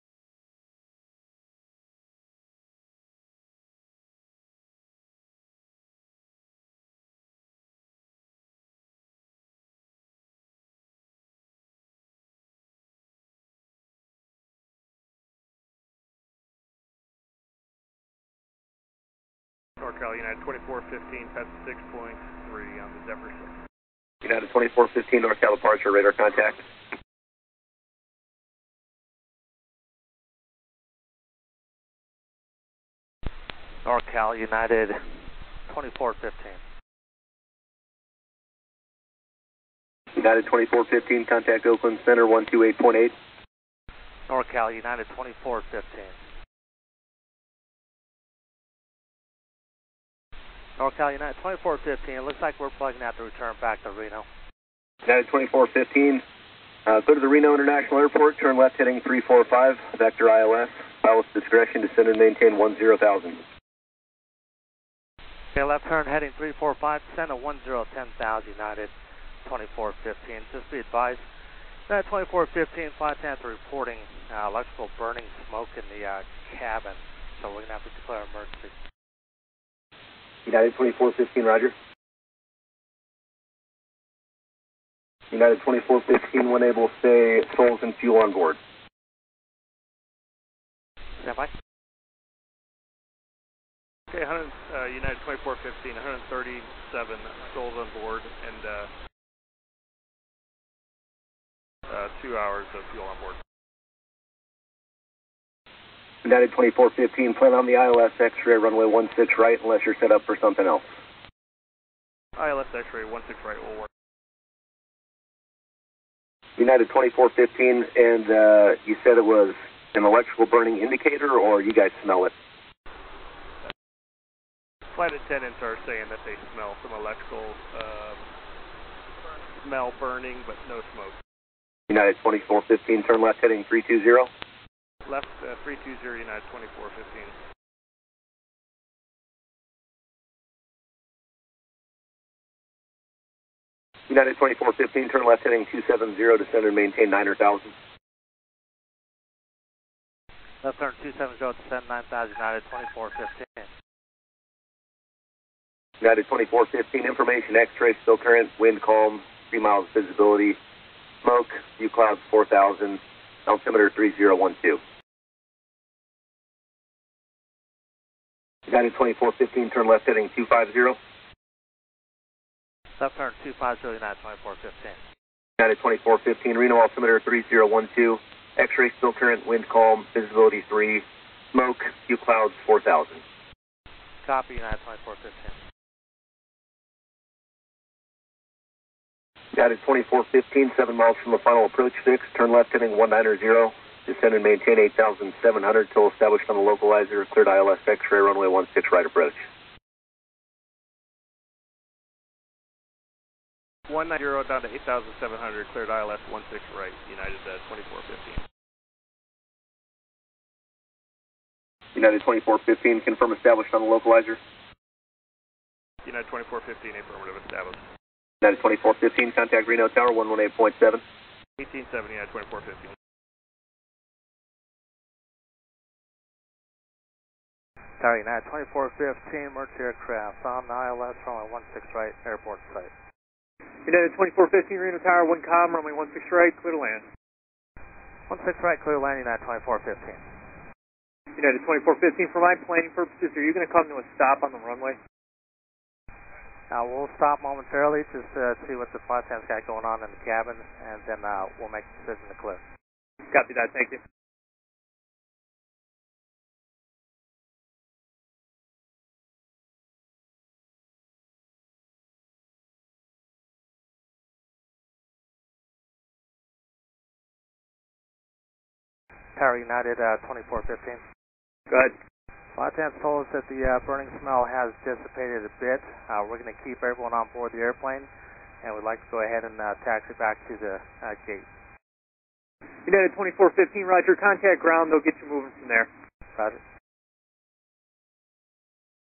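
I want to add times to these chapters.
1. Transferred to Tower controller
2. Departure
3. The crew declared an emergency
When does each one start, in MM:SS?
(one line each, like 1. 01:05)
1. 03:32
2. 00:17
3. 00:40.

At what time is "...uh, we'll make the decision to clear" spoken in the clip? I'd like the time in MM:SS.
04:11.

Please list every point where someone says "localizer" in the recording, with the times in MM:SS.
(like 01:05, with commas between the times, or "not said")
03:16, 03:33.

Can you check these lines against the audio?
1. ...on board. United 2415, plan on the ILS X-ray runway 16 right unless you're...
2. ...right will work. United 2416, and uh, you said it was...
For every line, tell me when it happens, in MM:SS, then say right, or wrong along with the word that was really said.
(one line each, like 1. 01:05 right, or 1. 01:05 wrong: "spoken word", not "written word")
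1. 01:43 right
2. 01:53 wrong: "2415", not "2416".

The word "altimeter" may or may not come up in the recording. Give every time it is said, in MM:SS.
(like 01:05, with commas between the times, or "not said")
02:43, 02:56.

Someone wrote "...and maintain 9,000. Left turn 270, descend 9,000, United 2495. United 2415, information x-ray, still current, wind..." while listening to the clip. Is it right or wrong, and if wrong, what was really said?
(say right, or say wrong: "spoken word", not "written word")
wrong: "2415", not "2495".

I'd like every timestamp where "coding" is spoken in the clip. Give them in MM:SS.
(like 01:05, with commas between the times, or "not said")
not said.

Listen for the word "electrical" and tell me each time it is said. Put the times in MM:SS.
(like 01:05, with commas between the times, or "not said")
01:14, 02:00, 02:06.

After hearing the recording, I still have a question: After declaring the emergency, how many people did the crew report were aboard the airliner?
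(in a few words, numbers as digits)
137.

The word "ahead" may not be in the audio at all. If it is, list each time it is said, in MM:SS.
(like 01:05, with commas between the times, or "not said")
04:31, 04:39.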